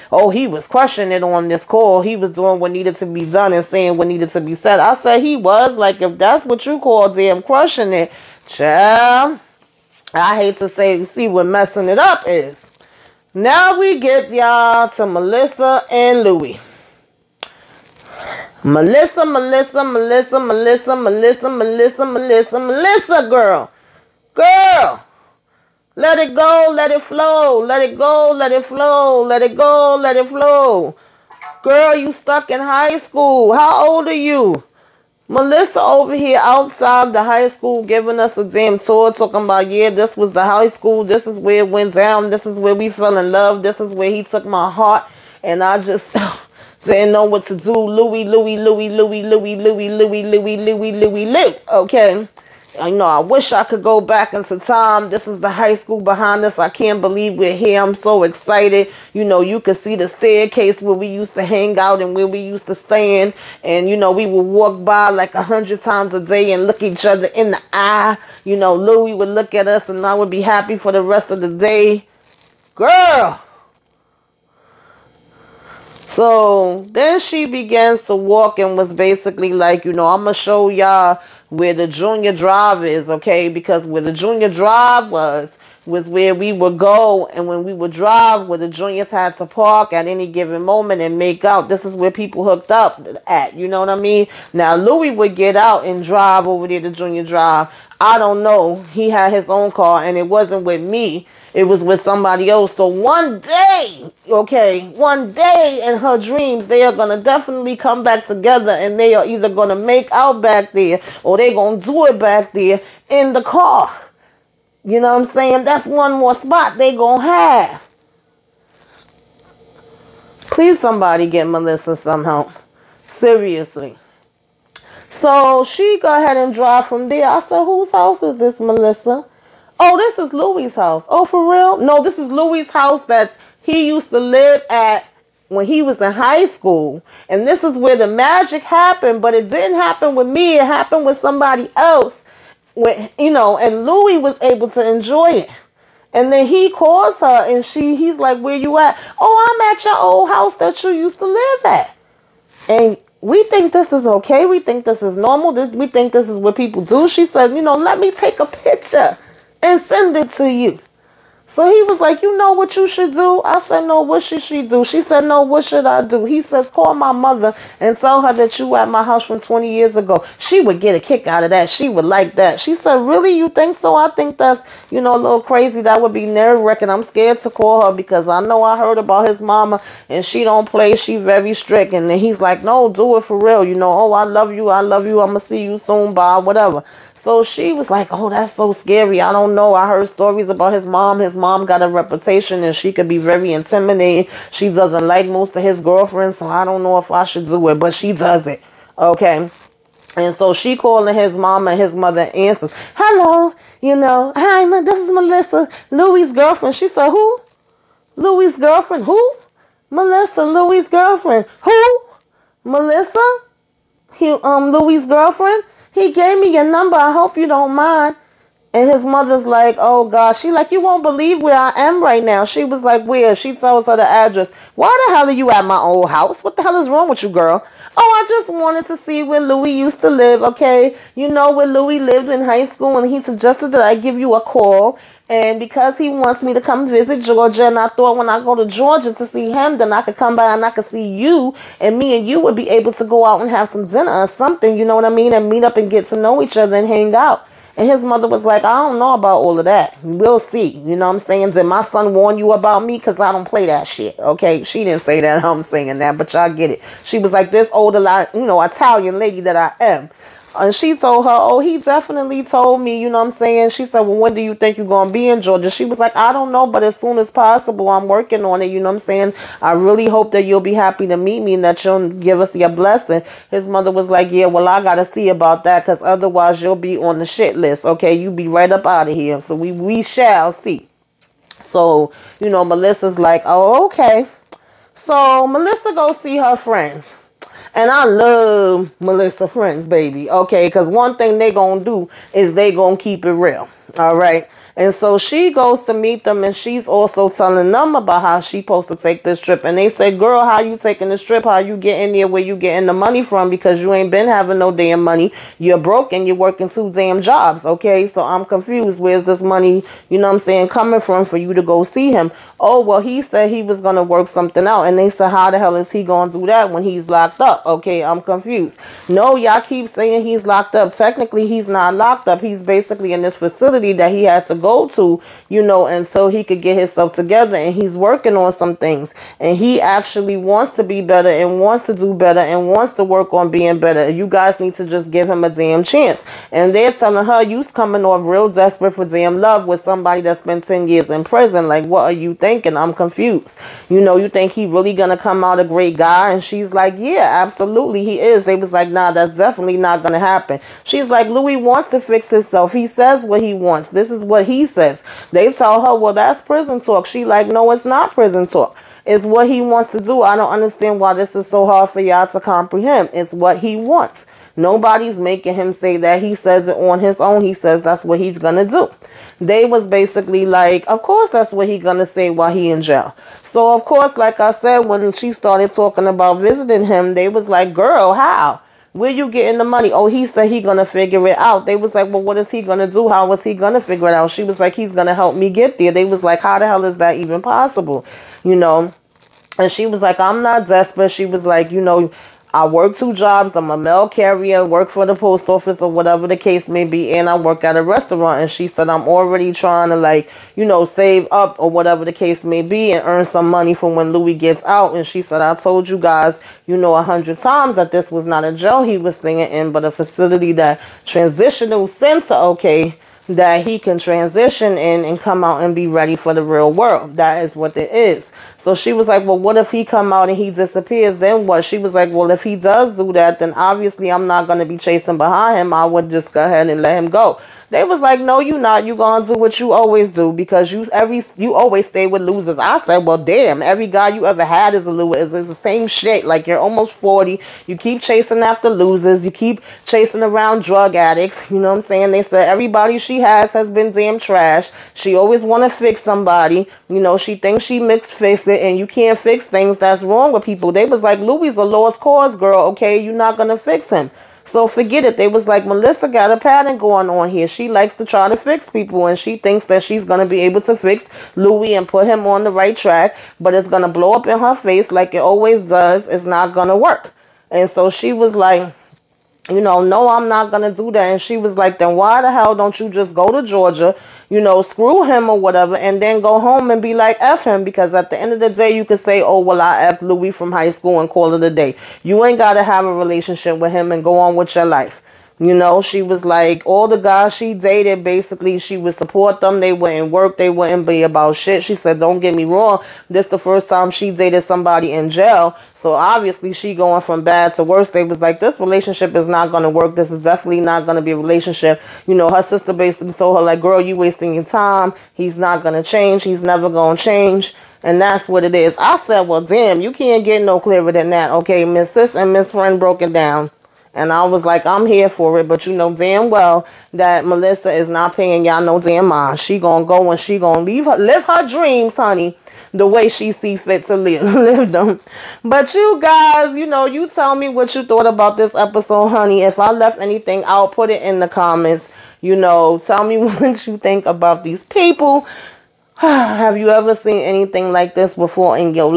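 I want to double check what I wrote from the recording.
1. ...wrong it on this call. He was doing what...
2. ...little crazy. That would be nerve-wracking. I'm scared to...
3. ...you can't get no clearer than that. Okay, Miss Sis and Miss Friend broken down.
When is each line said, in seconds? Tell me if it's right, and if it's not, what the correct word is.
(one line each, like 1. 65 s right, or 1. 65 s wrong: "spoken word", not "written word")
1. 0 s wrong: "crushing", not "wrong"
2. 175 s right
3. 509 s right.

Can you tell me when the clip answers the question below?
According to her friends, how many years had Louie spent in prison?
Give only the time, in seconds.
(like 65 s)
340 s.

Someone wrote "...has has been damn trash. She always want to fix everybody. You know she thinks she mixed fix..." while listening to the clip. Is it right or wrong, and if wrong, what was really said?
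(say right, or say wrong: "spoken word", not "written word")
wrong: "somebody", not "everybody".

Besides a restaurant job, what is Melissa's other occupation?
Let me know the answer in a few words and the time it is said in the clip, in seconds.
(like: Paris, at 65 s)
Mail carrier, at 393 s.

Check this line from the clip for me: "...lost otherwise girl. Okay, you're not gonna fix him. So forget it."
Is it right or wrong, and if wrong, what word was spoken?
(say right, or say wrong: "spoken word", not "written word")
wrong: "cause", not "otherwise".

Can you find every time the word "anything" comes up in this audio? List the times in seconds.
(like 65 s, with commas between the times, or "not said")
530 s, 537 s.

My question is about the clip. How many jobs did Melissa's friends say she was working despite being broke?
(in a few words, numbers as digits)
2.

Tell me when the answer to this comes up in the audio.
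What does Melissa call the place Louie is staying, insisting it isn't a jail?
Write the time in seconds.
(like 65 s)
411 s.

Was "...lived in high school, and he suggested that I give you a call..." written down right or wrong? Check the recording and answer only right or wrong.
right.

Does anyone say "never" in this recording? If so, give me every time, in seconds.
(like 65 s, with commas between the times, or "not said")
506 s.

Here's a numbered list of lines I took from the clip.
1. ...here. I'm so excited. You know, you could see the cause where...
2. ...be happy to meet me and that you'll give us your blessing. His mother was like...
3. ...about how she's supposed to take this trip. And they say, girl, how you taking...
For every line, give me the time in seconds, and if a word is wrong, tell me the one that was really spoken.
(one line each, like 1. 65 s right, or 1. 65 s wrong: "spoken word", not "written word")
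1. 57 s wrong: "staircase", not "cause"
2. 270 s right
3. 297 s right.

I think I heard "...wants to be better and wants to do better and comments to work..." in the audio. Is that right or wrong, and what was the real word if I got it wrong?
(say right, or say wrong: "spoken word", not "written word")
wrong: "wants", not "comments".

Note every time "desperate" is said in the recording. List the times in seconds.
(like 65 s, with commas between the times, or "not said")
338 s, 390 s.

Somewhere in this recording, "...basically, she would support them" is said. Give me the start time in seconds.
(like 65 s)
488 s.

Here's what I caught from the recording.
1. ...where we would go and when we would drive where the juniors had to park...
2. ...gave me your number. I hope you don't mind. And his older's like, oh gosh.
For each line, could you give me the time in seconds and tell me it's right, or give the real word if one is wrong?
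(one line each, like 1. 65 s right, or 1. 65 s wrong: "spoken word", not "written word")
1. 86 s right
2. 216 s wrong: "mother", not "older".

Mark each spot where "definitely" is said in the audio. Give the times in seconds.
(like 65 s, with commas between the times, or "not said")
107 s, 261 s, 349 s, 500 s.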